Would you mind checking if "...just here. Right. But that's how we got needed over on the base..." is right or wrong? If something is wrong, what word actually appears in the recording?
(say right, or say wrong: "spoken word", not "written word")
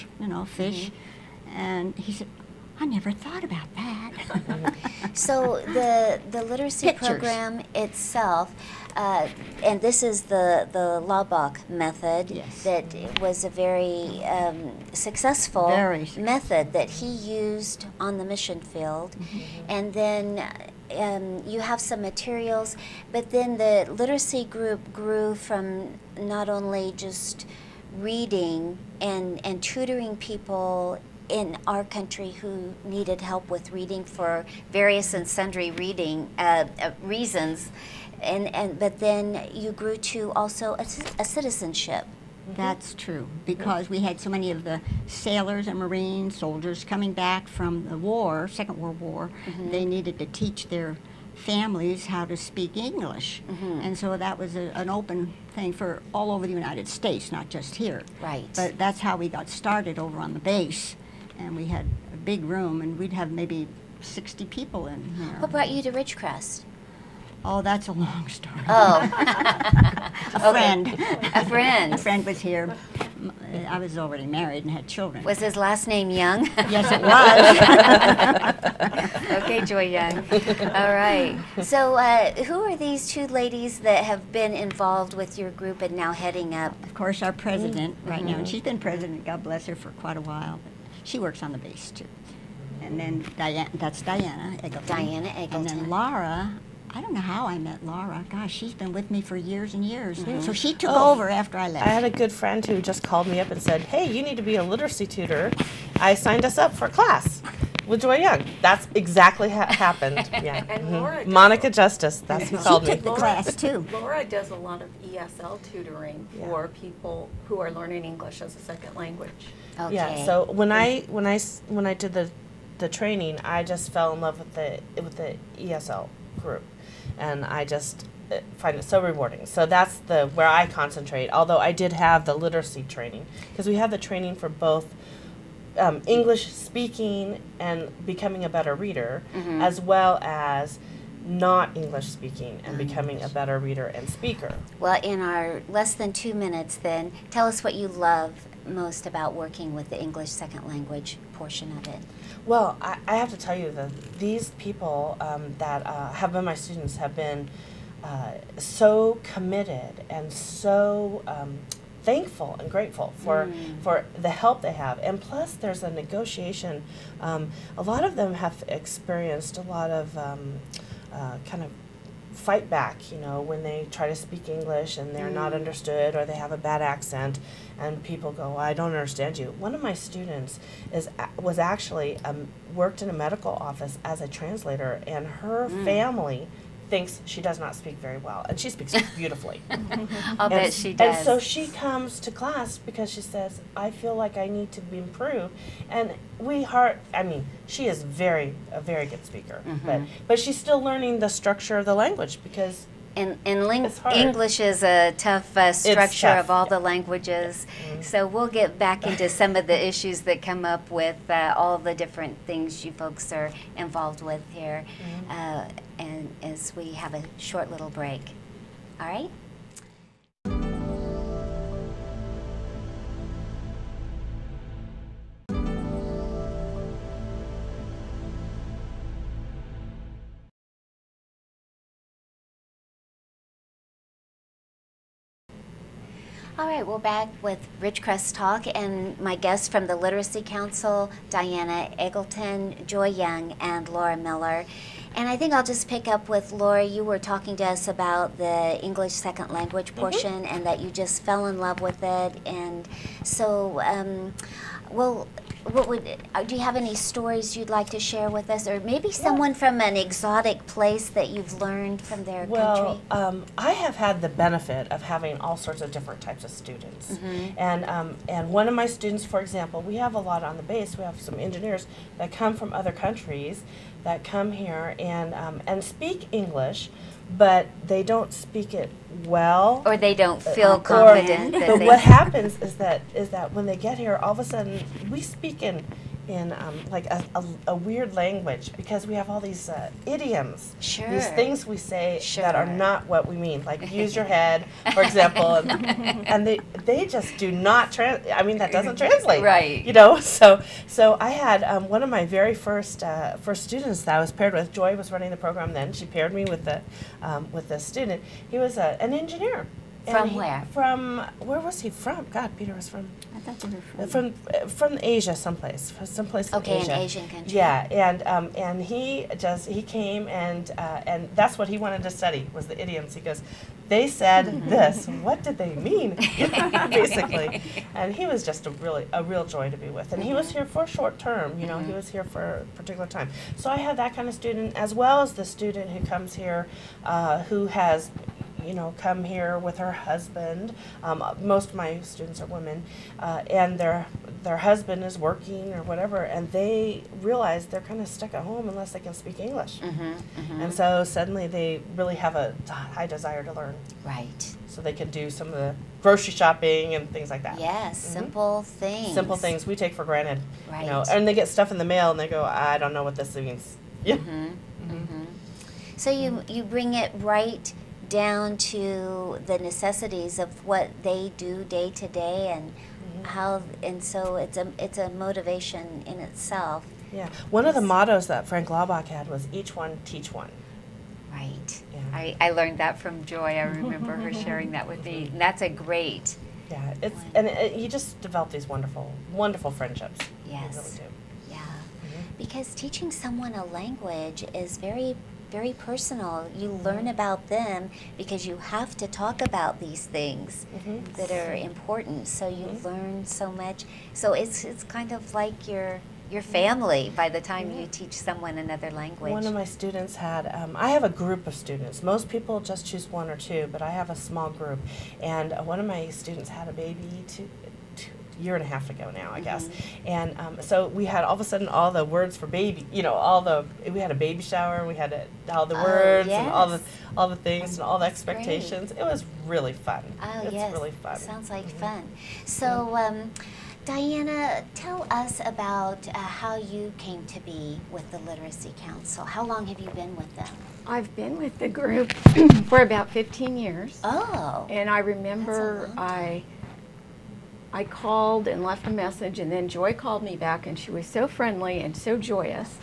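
wrong: "started", not "needed".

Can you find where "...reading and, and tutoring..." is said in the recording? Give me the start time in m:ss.
0:28.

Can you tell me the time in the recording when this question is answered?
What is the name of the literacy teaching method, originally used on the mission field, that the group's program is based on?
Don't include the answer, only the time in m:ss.
0:11.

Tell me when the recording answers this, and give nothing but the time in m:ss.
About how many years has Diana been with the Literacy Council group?
7:23.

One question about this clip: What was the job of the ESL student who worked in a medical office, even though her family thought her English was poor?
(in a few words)
Translator.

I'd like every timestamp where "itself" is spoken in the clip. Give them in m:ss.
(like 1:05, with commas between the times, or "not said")
0:07, 6:16.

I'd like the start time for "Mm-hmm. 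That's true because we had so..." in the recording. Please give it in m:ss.
0:42.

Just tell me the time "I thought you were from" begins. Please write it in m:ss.
5:13.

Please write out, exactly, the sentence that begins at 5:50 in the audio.
and so suddenly they really have a high desire to learn.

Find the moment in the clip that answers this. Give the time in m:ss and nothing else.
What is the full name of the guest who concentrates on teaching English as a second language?
4:03.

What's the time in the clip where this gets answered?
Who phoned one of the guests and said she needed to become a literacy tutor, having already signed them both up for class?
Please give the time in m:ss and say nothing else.
1:51.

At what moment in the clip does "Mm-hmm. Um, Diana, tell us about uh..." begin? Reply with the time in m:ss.
7:12.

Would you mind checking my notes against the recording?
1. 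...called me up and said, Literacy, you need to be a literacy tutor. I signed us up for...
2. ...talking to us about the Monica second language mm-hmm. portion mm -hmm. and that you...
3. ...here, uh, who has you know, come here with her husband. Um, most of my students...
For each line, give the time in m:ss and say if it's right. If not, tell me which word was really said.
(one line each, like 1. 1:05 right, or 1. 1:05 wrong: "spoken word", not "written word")
1. 1:43 wrong: "Hey", not "Literacy"
2. 4:07 wrong: "English", not "Monica"
3. 5:36 right.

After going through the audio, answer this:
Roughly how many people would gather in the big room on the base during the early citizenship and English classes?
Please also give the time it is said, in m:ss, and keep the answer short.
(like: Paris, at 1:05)
60, at 1:04.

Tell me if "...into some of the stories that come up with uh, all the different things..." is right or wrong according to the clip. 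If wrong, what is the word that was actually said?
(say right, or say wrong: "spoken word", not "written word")
wrong: "issues", not "stories".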